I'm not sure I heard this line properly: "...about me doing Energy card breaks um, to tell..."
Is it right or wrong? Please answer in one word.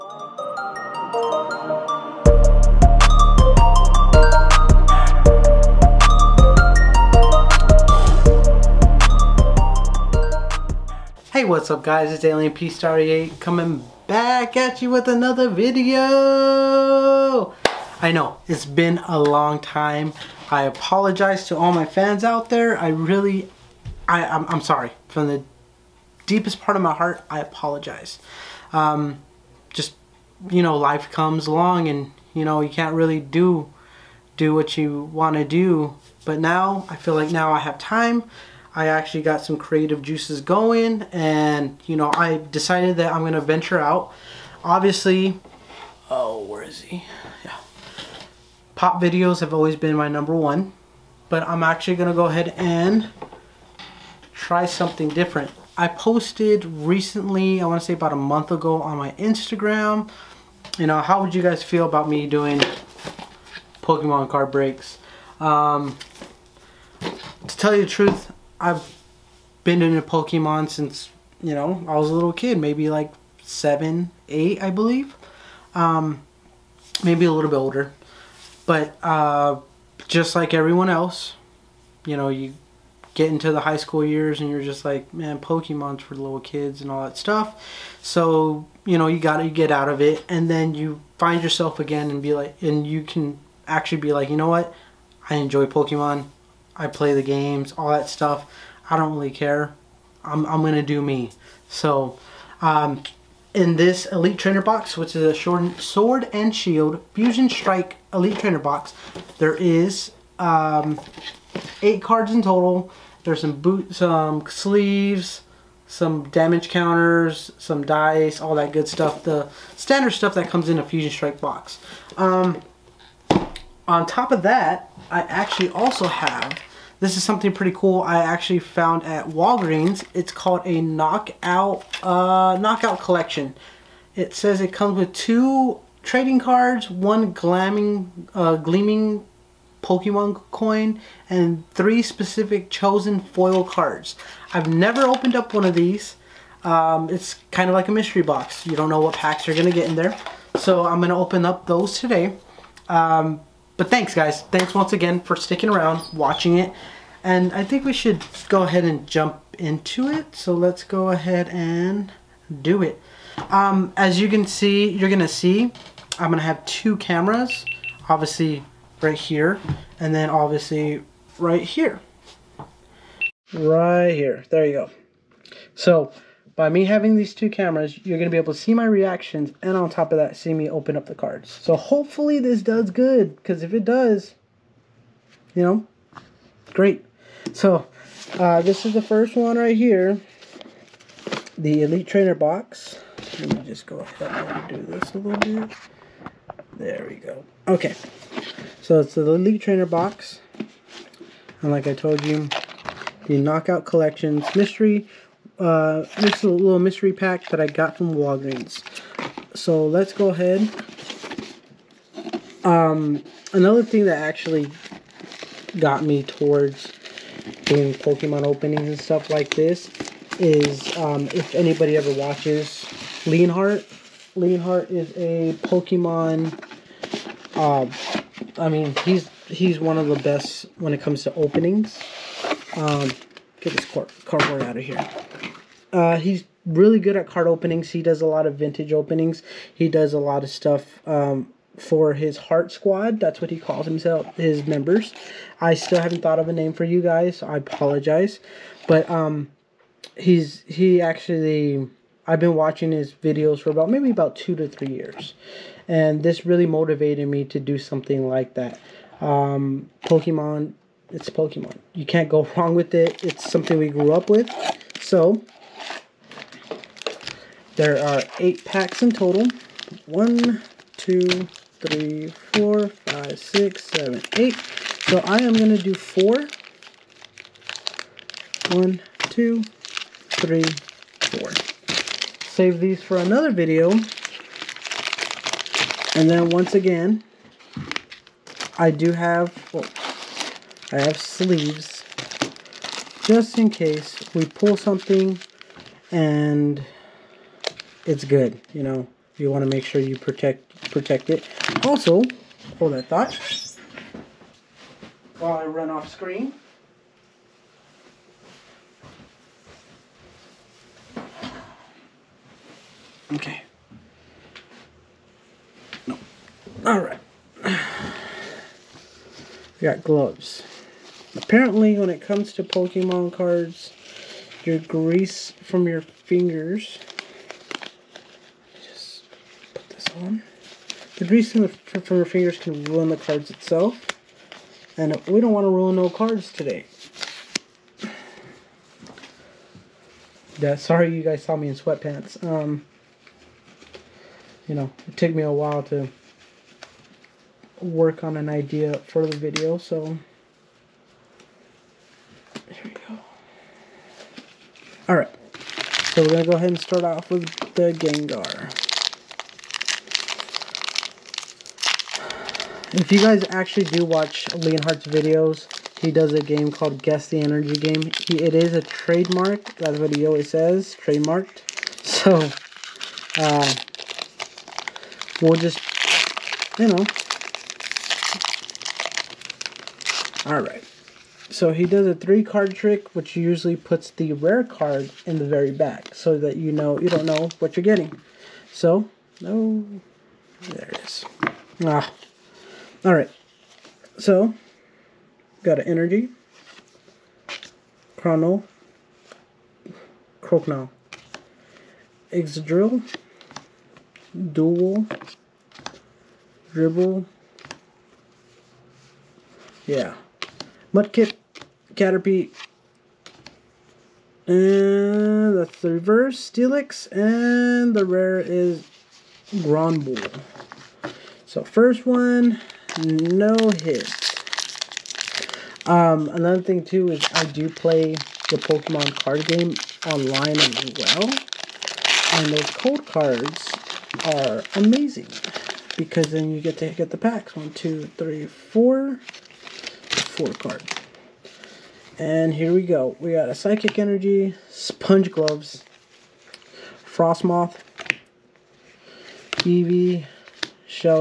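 wrong.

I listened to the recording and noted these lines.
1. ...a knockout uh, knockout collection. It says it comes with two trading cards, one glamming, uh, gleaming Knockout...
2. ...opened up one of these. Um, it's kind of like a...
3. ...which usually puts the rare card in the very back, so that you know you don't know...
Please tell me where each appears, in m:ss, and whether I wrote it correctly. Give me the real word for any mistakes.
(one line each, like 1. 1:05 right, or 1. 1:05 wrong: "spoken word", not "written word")
1. 2:10 wrong: "Pokemon", not "Knockout"
2. 2:25 right
3. 6:23 right.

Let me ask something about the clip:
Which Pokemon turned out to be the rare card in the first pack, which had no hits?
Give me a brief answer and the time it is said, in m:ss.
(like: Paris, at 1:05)
Granbull, at 6:59.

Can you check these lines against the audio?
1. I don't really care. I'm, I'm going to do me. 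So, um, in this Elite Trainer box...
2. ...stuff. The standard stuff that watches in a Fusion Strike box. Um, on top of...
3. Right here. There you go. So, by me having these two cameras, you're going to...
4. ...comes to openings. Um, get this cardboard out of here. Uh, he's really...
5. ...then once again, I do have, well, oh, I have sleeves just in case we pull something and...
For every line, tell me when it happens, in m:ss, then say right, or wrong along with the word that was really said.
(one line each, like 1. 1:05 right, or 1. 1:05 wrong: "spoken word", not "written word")
1. 1:38 right
2. 1:58 wrong: "comes", not "watches"
3. 2:53 right
4. 3:51 right
5. 4:46 right.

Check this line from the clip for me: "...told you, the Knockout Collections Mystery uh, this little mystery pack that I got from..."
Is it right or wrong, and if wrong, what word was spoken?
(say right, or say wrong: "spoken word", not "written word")
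right.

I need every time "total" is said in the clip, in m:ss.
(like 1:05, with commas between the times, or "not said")
1:52, 4:29.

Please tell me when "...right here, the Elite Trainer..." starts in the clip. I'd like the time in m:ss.
3:09.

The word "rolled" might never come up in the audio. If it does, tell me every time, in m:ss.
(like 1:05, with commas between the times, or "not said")
not said.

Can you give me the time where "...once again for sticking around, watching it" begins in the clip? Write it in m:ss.
2:34.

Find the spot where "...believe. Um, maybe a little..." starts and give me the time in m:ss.
1:14.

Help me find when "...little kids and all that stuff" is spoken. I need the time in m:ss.
1:26.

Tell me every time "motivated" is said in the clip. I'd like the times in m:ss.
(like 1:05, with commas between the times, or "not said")
4:16.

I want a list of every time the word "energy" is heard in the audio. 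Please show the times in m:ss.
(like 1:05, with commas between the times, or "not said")
6:07, 6:35, 7:23.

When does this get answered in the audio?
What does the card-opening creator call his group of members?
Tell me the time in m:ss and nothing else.
4:02.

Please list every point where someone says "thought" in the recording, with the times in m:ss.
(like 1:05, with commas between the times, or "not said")
4:06, 5:03.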